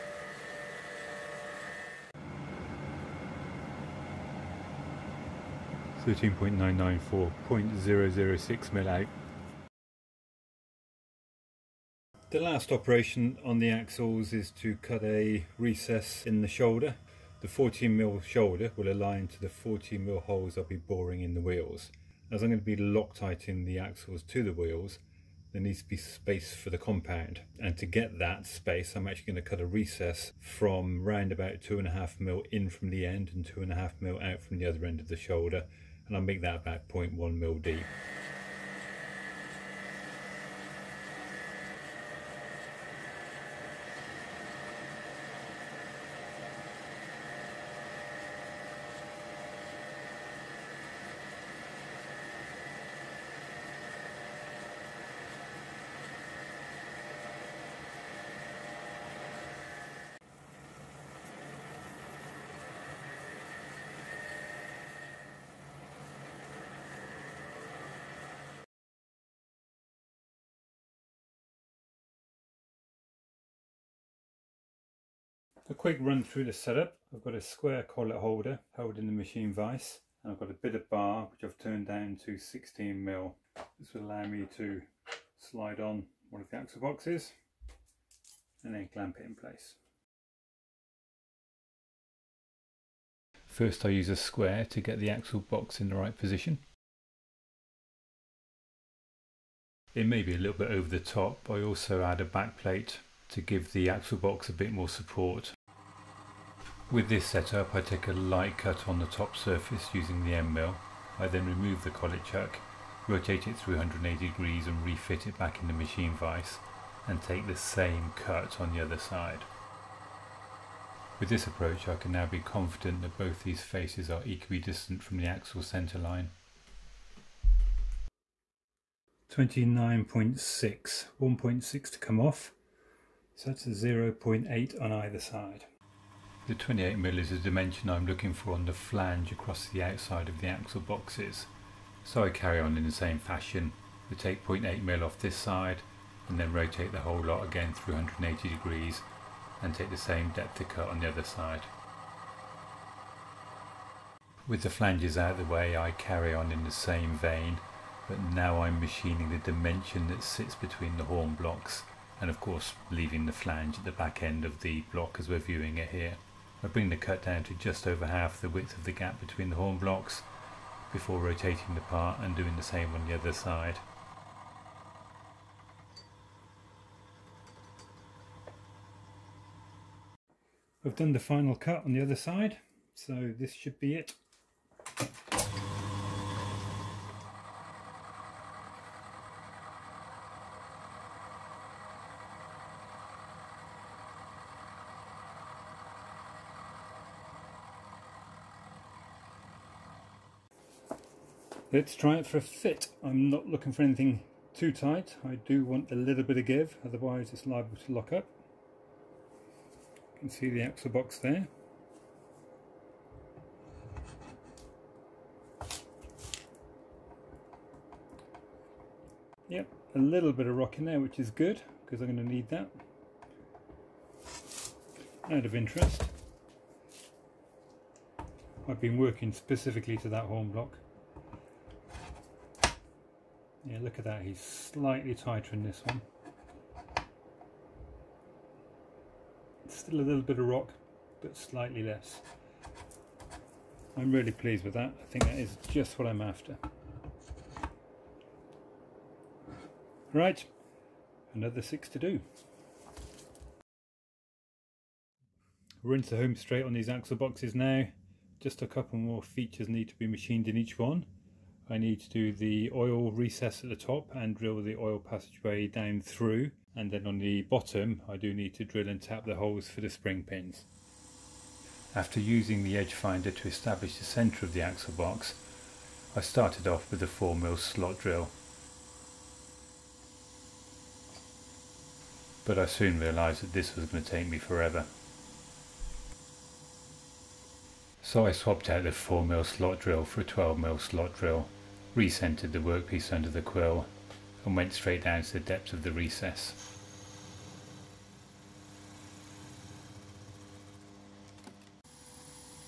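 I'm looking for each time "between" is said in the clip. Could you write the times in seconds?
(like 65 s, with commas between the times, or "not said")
160 s, 169 s.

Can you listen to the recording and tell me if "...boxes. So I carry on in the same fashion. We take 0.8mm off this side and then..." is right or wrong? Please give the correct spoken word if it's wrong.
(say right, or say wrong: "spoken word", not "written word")
right.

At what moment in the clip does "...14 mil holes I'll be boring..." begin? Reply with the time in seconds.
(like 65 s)
19 s.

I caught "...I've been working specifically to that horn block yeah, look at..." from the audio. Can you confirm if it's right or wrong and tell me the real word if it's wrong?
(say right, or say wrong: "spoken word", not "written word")
right.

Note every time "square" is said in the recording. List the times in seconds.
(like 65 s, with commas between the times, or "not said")
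77 s, 94 s.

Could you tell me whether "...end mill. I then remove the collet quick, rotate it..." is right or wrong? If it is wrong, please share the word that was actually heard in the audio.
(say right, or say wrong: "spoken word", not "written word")
wrong: "chuck", not "quick".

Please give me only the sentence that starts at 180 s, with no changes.
I've done the final cut on the other side so this should be it.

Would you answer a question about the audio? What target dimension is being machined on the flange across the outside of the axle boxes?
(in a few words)
28mm.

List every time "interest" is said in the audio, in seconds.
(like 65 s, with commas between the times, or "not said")
225 s.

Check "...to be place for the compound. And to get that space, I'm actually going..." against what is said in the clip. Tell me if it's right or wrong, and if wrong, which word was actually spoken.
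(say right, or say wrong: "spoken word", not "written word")
wrong: "space", not "place".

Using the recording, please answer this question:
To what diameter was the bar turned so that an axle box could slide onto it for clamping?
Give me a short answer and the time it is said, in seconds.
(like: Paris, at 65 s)
16mm, at 82 s.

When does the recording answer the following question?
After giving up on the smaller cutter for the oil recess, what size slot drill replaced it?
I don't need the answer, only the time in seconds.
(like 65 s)
290 s.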